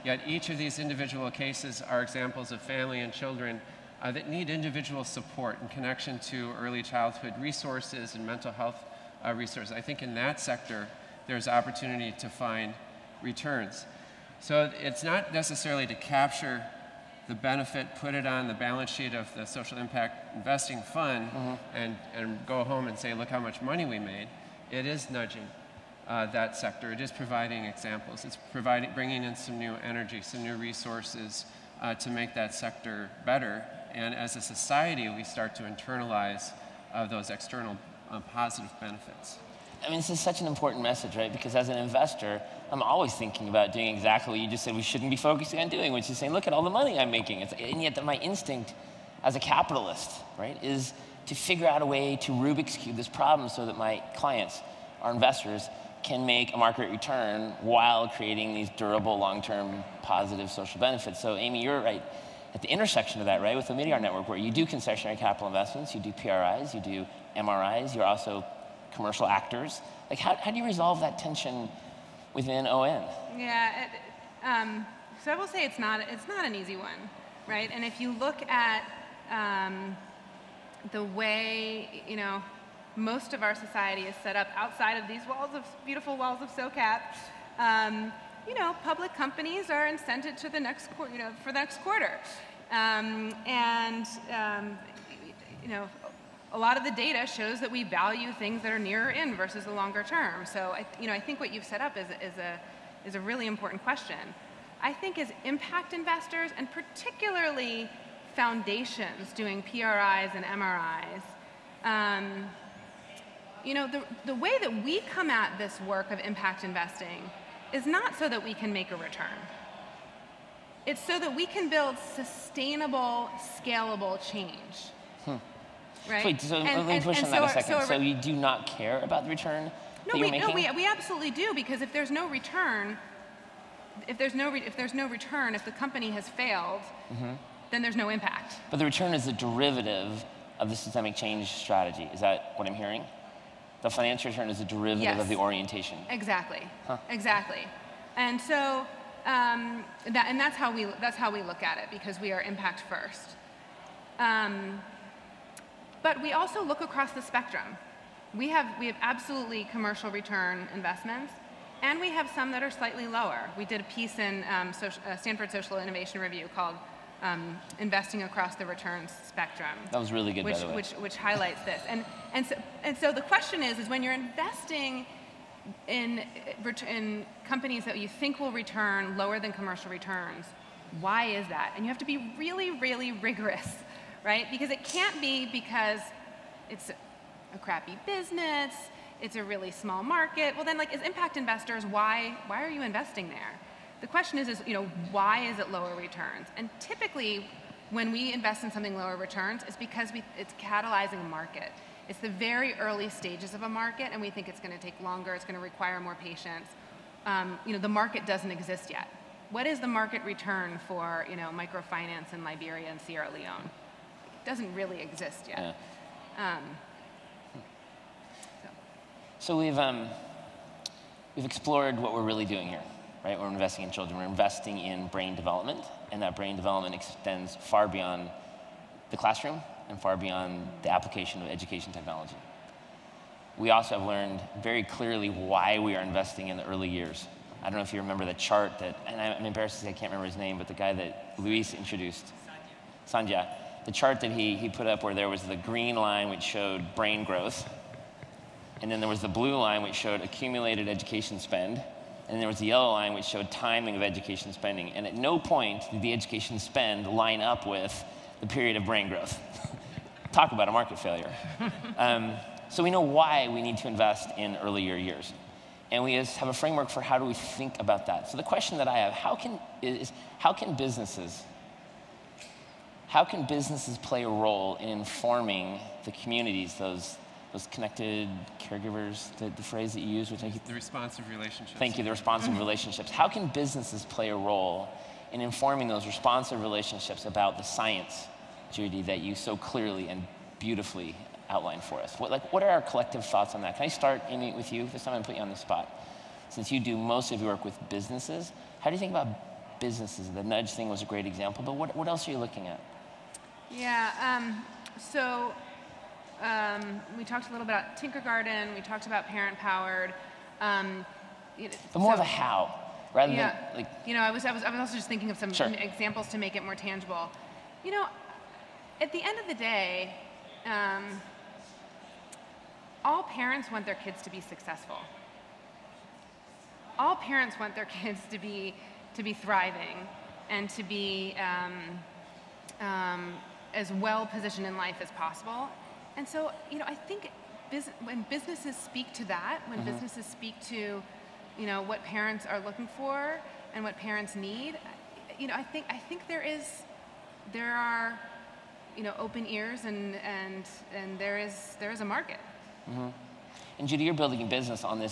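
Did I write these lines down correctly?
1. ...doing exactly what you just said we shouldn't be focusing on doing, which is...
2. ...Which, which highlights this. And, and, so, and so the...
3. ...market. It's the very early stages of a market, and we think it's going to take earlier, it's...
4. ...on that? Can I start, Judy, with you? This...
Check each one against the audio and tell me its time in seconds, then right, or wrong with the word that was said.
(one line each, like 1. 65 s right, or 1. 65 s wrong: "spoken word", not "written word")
1. 43 s right
2. 170 s right
3. 201 s wrong: "longer", not "earlier"
4. 293 s wrong: "Amy", not "Judy".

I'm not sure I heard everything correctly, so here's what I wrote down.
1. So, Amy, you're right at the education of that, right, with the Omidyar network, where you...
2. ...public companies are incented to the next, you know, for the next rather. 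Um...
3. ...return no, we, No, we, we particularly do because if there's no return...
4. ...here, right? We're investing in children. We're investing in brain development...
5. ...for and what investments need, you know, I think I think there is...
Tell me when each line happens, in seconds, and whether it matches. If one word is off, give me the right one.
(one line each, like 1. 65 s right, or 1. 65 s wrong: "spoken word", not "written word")
1. 61 s wrong: "intersection", not "education"
2. 88 s wrong: "quarter", not "rather"
3. 129 s wrong: "absolutely", not "particularly"
4. 222 s right
5. 342 s wrong: "parents", not "investments".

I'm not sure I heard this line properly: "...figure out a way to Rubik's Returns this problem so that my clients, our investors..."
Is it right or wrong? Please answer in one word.
wrong.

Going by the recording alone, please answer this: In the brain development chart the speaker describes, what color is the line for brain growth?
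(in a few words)
Green.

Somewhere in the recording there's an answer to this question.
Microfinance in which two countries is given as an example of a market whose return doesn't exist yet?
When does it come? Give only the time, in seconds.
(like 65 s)
212 s.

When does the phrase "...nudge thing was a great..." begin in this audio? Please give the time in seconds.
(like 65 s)
300 s.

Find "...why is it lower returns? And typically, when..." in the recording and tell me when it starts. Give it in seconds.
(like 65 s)
195 s.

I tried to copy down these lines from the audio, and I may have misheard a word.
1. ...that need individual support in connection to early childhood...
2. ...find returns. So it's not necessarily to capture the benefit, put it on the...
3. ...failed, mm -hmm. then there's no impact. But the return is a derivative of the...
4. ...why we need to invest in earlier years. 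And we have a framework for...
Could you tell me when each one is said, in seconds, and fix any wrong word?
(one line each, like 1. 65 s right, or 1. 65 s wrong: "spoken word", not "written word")
1. 4 s right
2. 12 s right
3. 136 s right
4. 263 s right.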